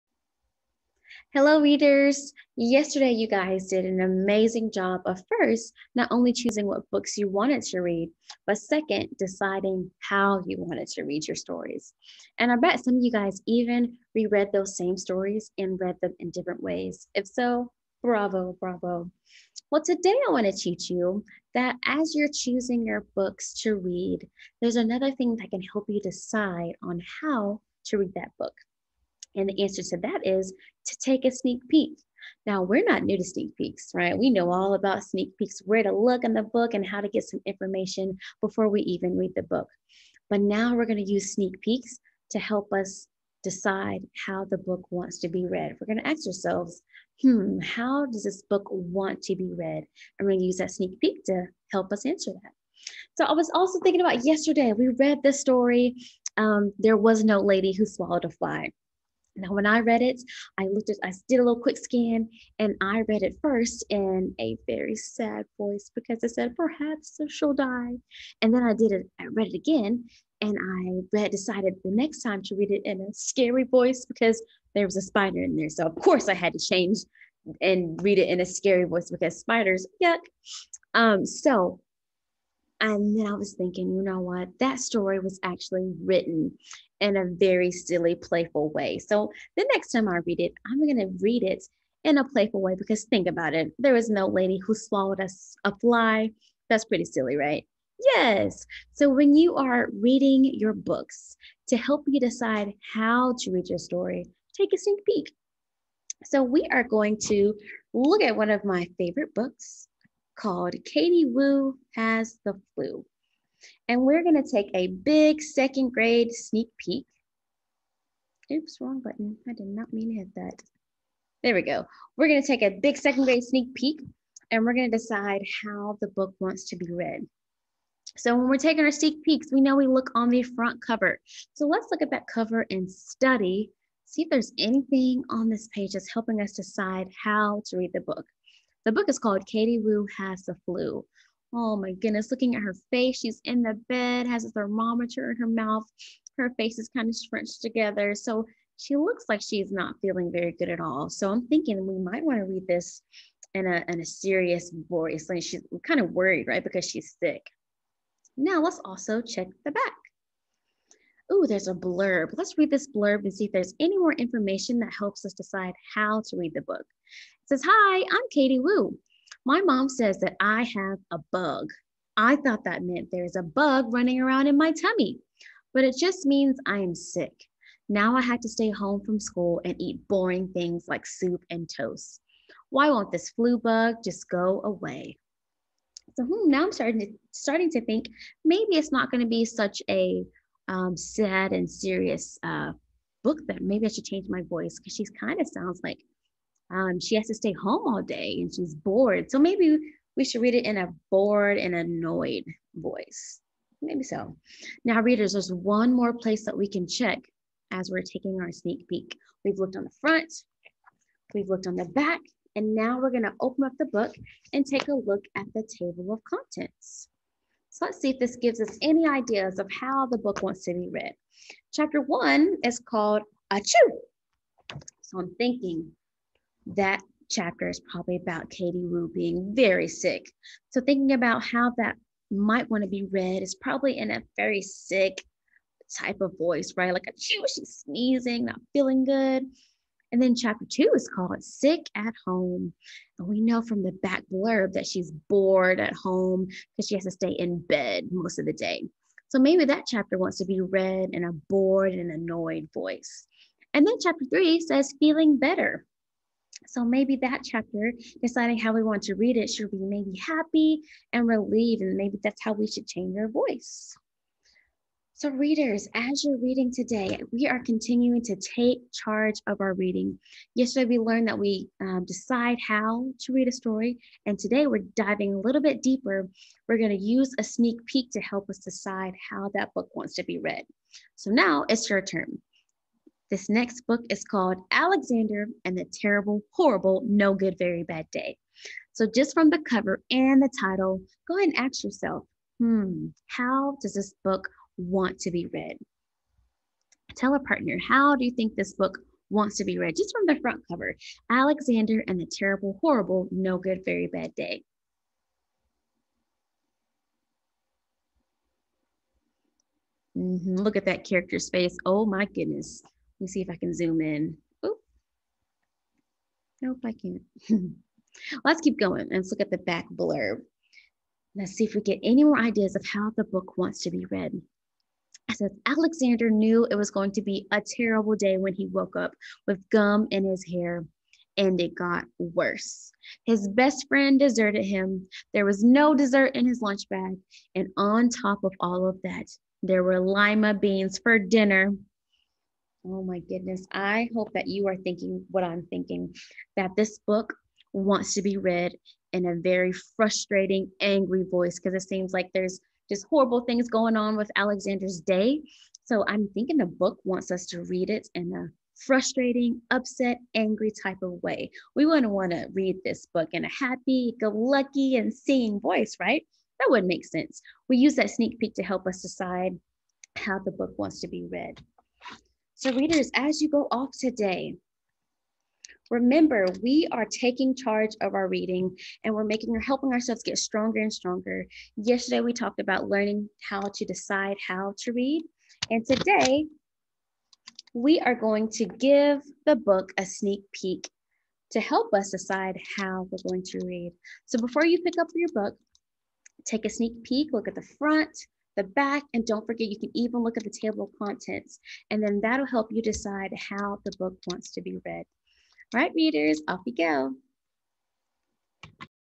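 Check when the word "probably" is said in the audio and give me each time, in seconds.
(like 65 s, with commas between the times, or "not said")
227 s, 233 s.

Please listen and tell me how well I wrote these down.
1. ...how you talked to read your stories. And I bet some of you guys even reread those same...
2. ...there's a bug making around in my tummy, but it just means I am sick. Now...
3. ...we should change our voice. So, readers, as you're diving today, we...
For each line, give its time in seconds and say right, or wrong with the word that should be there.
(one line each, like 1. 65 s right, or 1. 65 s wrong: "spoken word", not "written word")
1. 9 s wrong: "wanted", not "talked"
2. 173 s wrong: "running", not "making"
3. 262 s wrong: "reading", not "diving".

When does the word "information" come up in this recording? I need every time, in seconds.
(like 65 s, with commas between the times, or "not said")
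37 s, 164 s.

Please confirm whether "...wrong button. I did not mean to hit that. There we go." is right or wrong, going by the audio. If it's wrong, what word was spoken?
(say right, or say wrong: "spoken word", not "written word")
right.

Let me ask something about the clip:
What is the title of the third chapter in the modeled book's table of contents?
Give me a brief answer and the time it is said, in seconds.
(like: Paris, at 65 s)
Feeling Better, at 254 s.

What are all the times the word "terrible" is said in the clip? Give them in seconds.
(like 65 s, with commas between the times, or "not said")
285 s, 302 s, 327 s.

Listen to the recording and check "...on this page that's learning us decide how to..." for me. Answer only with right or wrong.
wrong.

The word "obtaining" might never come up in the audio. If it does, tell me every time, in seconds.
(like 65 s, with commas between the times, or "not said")
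not said.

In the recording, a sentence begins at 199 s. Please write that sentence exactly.
So maybe we should read it in a bored and annoyed voice.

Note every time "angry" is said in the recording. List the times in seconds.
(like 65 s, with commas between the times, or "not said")
350 s, 360 s.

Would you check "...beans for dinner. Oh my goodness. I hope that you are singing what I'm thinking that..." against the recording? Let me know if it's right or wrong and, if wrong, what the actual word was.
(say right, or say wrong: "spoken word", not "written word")
wrong: "thinking", not "singing".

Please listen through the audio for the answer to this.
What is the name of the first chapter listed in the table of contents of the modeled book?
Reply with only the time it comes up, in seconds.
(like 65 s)
223 s.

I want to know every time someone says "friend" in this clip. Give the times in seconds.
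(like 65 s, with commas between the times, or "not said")
333 s.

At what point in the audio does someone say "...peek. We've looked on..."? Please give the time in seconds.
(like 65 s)
208 s.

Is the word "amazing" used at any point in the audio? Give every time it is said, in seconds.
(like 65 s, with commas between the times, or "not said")
4 s.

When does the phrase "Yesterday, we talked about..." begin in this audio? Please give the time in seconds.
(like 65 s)
381 s.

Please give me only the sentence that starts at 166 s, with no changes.
It says, Hi, I'm Katie Woo.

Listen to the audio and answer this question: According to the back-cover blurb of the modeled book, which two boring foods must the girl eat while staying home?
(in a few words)
Soup and toast.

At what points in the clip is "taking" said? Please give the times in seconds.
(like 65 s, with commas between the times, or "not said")
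128 s, 208 s, 377 s.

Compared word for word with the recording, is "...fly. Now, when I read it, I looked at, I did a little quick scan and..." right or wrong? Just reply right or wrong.
right.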